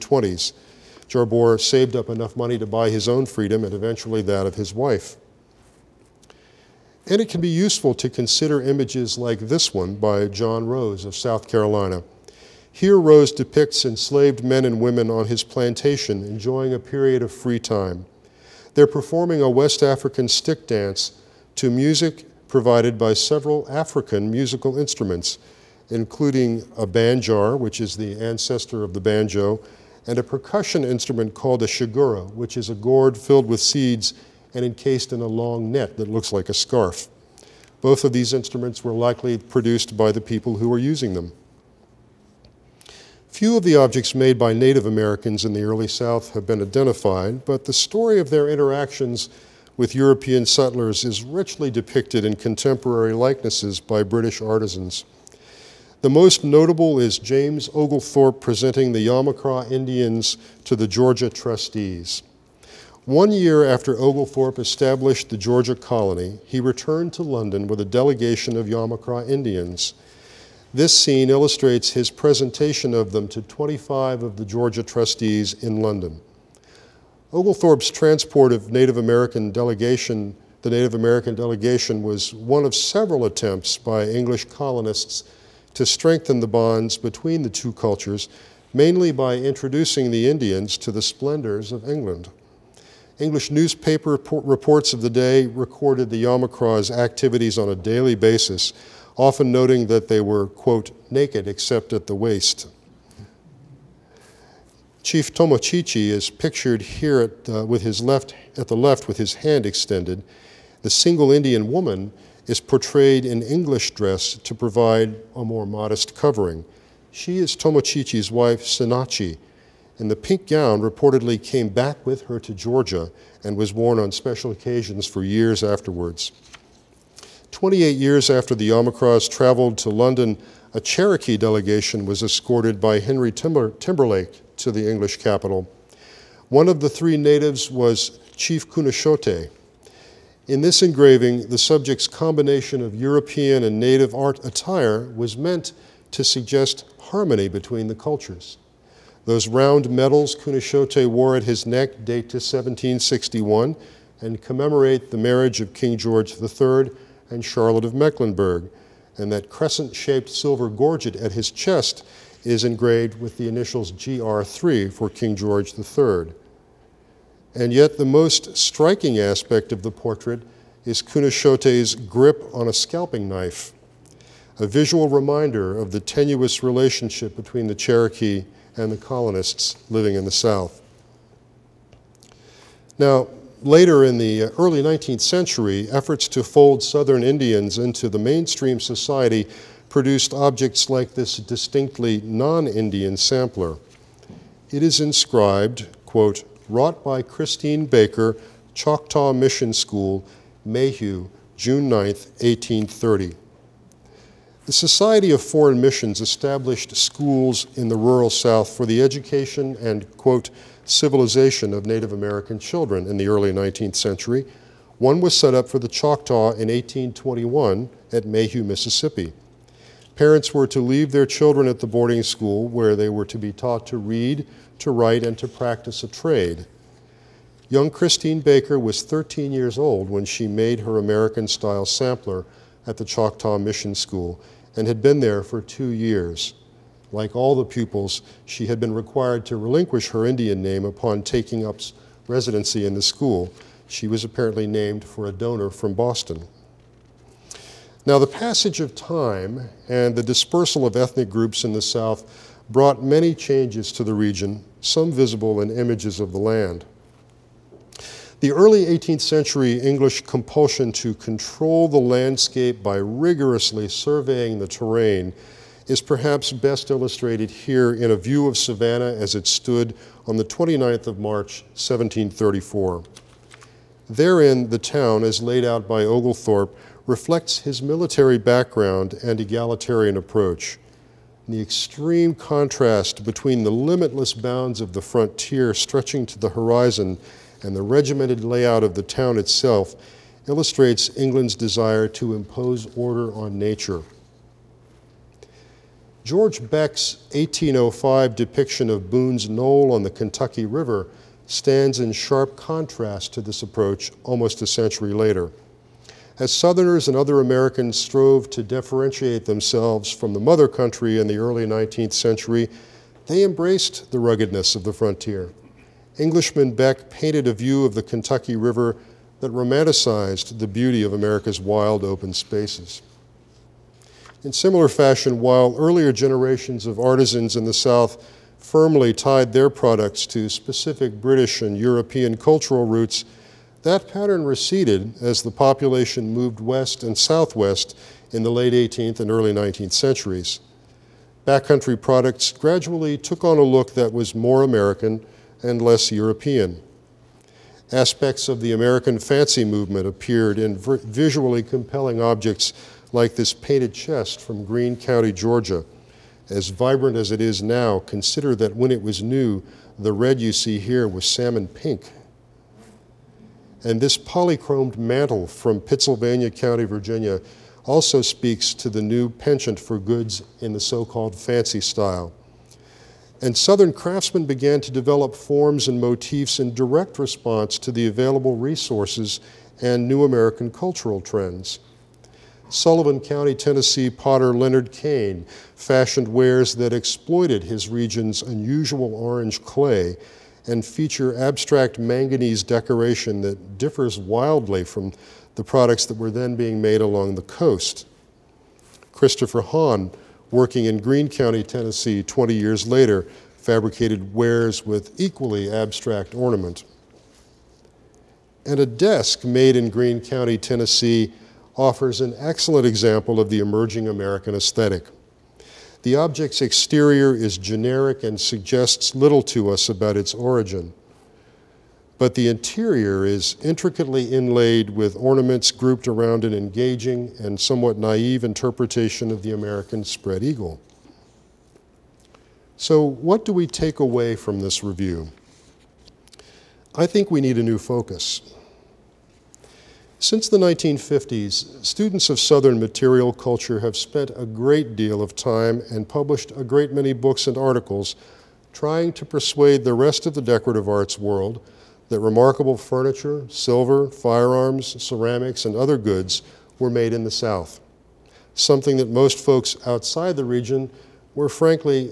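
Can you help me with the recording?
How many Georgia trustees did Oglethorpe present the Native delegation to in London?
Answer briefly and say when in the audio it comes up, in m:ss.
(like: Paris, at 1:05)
25, at 1:13.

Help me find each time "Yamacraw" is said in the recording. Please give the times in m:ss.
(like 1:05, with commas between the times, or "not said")
0:59, 1:08, 1:36, 2:08.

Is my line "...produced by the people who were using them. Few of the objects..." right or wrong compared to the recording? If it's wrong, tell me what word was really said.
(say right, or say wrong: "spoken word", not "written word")
right.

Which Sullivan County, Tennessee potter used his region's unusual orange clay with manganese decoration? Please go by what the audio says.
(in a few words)
Leonard Cain.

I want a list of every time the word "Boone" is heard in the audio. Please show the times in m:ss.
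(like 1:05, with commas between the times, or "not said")
4:59.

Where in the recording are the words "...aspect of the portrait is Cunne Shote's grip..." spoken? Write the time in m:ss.
2:49.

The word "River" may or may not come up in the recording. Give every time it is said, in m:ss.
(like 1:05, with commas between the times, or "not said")
5:00, 5:18.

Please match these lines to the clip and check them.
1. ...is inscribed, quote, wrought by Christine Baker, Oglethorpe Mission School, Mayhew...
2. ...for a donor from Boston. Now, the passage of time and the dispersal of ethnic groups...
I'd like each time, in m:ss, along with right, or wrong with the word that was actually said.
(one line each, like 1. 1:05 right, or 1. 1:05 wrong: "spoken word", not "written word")
1. 3:14 wrong: "Choctaw", not "Oglethorpe"
2. 4:05 right.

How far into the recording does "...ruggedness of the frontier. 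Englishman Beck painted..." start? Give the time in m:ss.
5:14.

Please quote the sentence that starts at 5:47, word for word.
Aspects of the American fancy movement appeared in visually compelling objects like this painted chest from Greene County, Georgia.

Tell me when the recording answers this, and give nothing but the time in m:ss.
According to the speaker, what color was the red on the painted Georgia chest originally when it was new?
6:01.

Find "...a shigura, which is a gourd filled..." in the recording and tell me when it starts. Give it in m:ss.
0:31.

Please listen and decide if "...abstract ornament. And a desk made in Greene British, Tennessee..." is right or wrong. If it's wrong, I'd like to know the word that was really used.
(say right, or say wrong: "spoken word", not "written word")
wrong: "County", not "British".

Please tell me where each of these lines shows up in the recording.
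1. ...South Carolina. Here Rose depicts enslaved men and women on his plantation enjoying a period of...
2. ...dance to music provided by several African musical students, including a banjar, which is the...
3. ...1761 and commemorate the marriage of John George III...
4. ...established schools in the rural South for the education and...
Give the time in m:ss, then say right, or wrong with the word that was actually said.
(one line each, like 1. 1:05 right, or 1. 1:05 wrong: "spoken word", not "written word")
1. 0:11 right
2. 0:20 wrong: "instruments", not "students"
3. 2:32 wrong: "King", not "John"
4. 3:26 right.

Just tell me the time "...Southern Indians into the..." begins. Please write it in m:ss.
3:06.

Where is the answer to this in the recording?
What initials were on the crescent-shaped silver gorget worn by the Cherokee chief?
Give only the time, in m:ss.
2:43.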